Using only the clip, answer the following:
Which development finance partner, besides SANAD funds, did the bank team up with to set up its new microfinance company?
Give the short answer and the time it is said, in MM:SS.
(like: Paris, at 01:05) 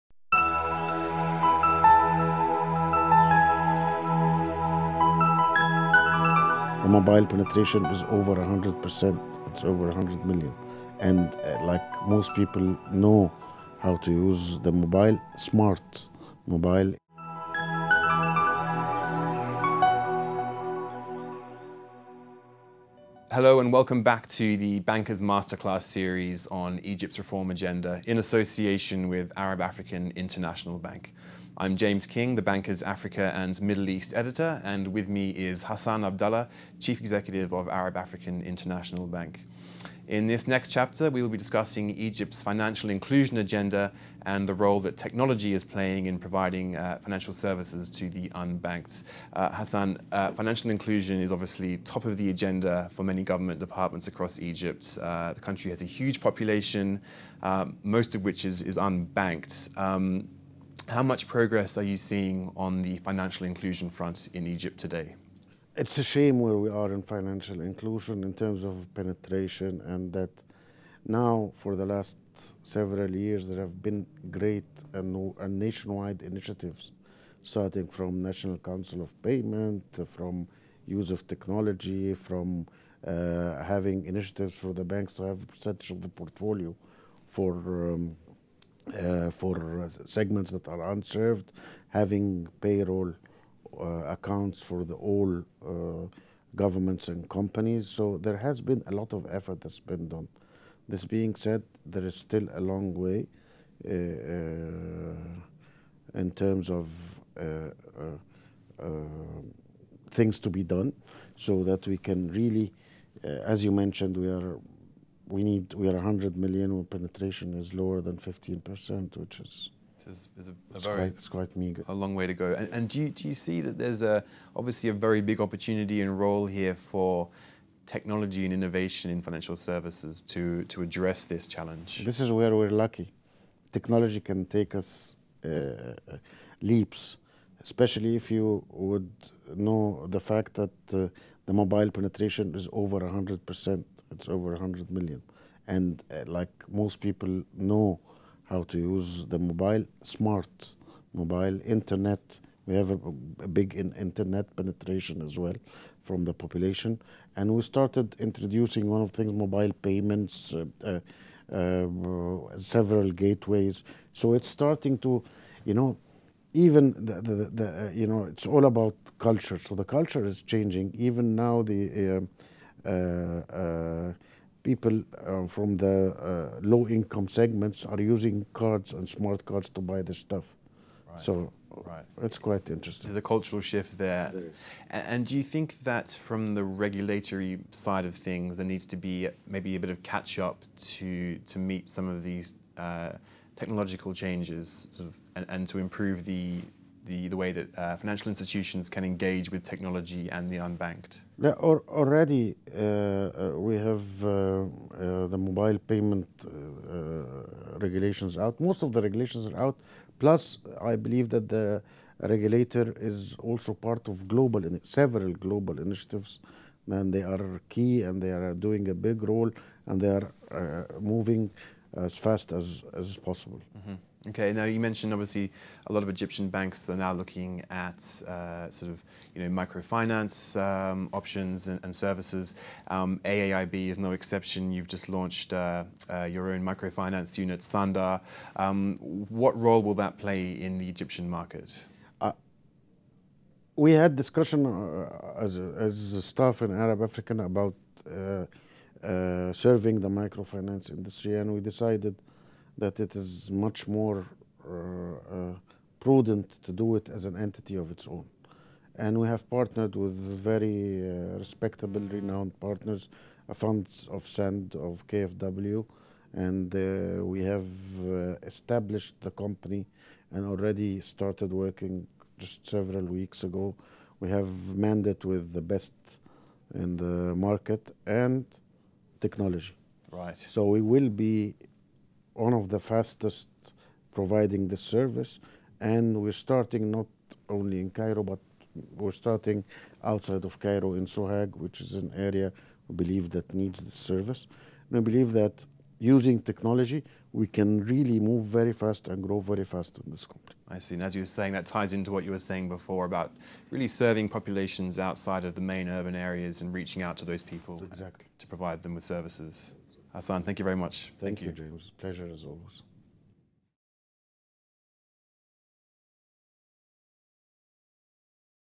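KfW, at 04:25.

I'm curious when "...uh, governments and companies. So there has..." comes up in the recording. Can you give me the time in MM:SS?
01:35.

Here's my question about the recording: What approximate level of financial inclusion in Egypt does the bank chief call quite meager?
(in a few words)
lower than 15%.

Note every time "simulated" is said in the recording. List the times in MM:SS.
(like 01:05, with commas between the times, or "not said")
not said.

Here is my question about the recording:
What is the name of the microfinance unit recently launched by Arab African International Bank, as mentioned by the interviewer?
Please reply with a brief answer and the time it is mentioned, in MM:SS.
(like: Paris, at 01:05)
Sanda, at 03:57.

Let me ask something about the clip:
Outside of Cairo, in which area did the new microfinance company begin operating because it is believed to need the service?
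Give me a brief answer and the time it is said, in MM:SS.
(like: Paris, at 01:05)
Sohag, at 04:51.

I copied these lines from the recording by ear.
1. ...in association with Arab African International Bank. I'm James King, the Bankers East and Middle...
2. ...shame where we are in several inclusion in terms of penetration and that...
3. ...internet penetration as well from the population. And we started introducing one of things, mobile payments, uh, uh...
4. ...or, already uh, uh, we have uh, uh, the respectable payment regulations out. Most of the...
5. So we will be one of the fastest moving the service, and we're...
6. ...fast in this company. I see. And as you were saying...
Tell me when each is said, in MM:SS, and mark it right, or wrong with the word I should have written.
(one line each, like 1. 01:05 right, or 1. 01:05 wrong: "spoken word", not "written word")
1. 00:28 wrong: "Africa", not "East"
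2. 01:06 wrong: "financial", not "several"
3. 02:33 right
4. 03:21 wrong: "mobile", not "respectable"
5. 04:40 wrong: "providing", not "moving"
6. 04:59 right.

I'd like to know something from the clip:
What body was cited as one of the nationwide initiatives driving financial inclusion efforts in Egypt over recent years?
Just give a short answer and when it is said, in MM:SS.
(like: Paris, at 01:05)
National Council of Payment, at 01:18.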